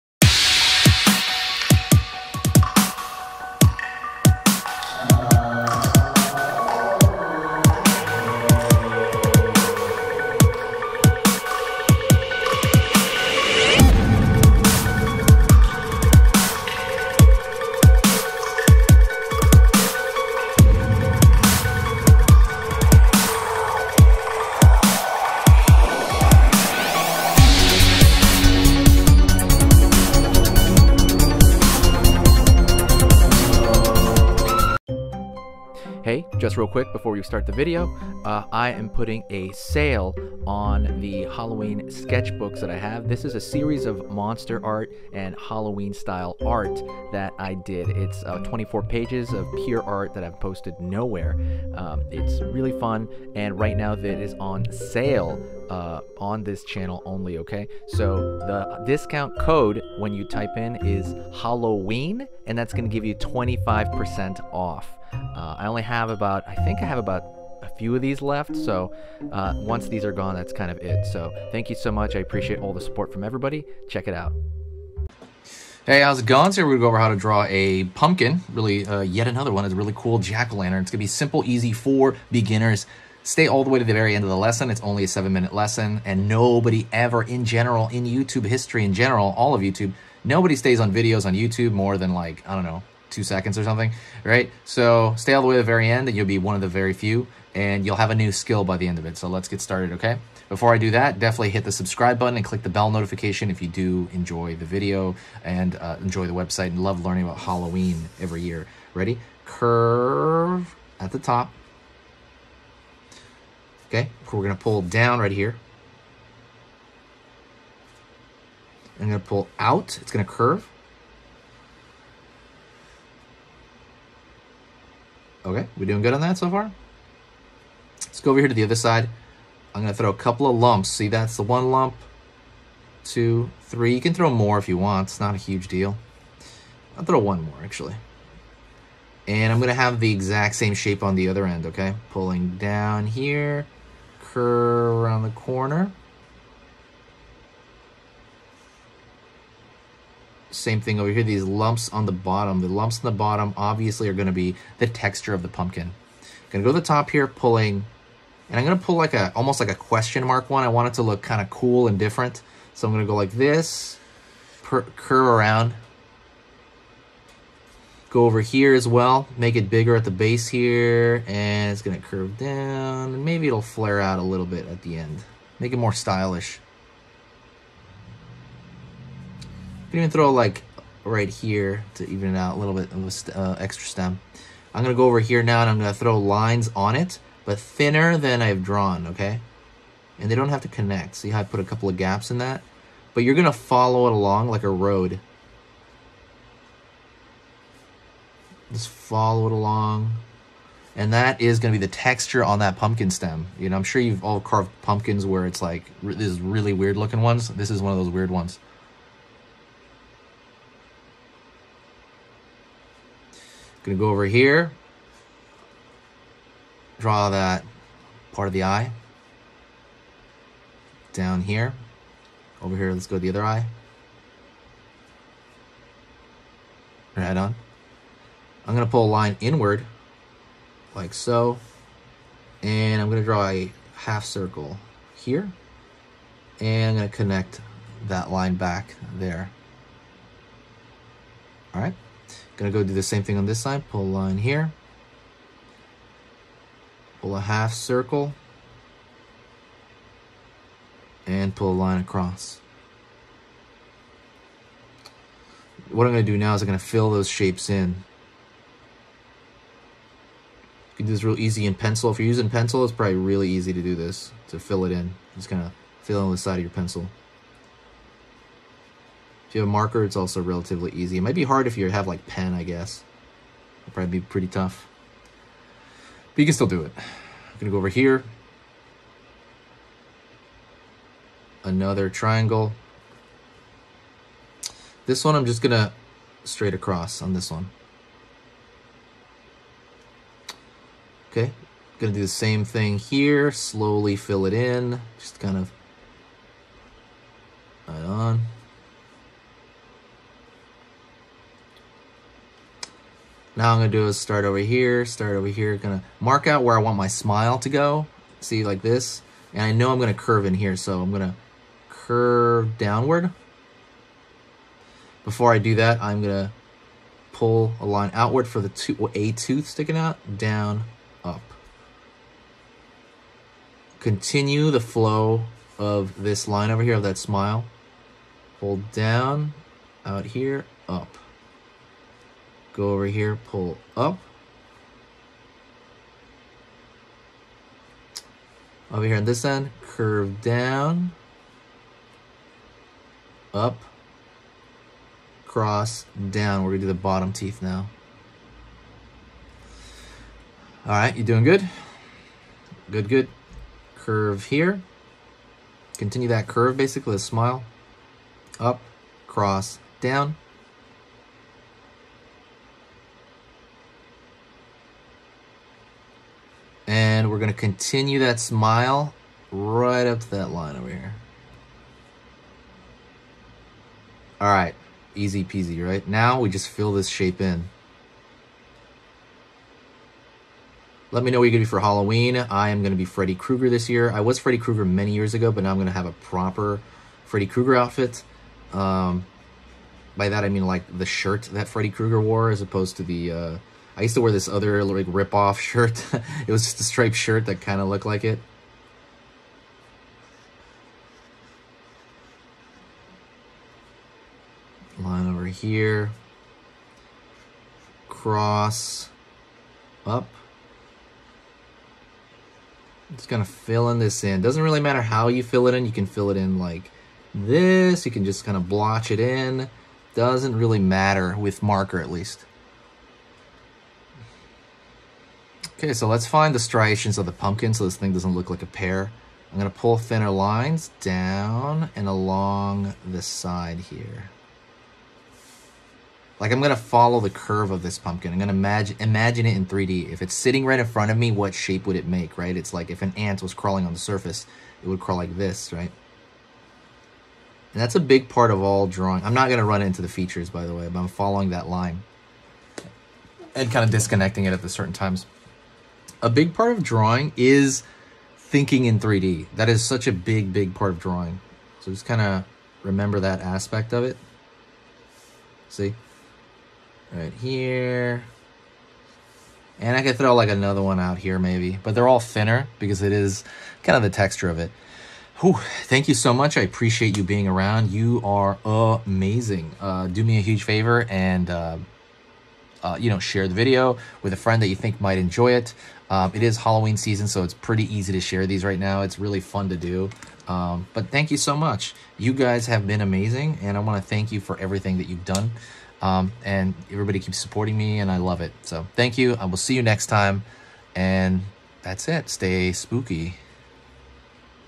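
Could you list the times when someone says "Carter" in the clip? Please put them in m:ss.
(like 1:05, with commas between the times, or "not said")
not said.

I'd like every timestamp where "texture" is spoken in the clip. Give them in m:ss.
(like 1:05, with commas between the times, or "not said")
2:34, 3:21, 7:54.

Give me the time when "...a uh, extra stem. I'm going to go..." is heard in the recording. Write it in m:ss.
3:03.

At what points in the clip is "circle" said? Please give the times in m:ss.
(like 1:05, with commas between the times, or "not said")
3:54, 4:07.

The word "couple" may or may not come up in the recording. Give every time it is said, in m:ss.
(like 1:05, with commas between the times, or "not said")
2:10, 3:11.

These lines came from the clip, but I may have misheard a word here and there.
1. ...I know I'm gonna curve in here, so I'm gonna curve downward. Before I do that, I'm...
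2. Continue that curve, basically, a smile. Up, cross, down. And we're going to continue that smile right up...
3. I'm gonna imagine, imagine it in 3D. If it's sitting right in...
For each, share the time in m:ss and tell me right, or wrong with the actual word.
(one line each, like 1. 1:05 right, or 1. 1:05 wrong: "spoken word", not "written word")
1. 5:09 right
2. 5:55 right
3. 7:18 right.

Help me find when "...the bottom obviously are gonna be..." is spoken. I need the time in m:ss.
2:33.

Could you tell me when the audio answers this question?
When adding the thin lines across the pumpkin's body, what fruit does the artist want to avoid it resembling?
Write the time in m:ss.
7:08.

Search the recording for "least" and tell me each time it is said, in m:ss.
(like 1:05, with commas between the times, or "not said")
7:02.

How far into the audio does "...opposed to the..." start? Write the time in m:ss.
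6:32.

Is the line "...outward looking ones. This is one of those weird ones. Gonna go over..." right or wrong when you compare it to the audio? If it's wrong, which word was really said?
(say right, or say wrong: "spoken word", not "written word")
wrong: "weird", not "outward".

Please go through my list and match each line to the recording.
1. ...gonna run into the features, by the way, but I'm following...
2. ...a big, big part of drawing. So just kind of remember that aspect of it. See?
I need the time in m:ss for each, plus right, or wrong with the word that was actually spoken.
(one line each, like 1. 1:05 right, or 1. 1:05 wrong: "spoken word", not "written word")
1. 7:29 right
2. 7:40 right.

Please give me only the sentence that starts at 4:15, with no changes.
What I'm gonna do now is I'm gonna fill those shapes in.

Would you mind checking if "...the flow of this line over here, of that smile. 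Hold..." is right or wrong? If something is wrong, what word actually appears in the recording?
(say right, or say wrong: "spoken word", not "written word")
right.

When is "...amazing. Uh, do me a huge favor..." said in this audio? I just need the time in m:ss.
7:58.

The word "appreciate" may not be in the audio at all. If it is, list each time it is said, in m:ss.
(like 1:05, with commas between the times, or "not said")
1:12, 7:56.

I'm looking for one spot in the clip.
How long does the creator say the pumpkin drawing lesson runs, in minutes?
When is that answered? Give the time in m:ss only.
1:25.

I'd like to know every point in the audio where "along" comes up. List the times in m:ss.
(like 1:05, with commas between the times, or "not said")
3:14, 3:19, 7:12.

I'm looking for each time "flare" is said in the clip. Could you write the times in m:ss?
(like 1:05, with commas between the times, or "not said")
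2:53.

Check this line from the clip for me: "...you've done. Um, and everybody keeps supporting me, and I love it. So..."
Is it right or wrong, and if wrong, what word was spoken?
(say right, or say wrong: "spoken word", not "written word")
right.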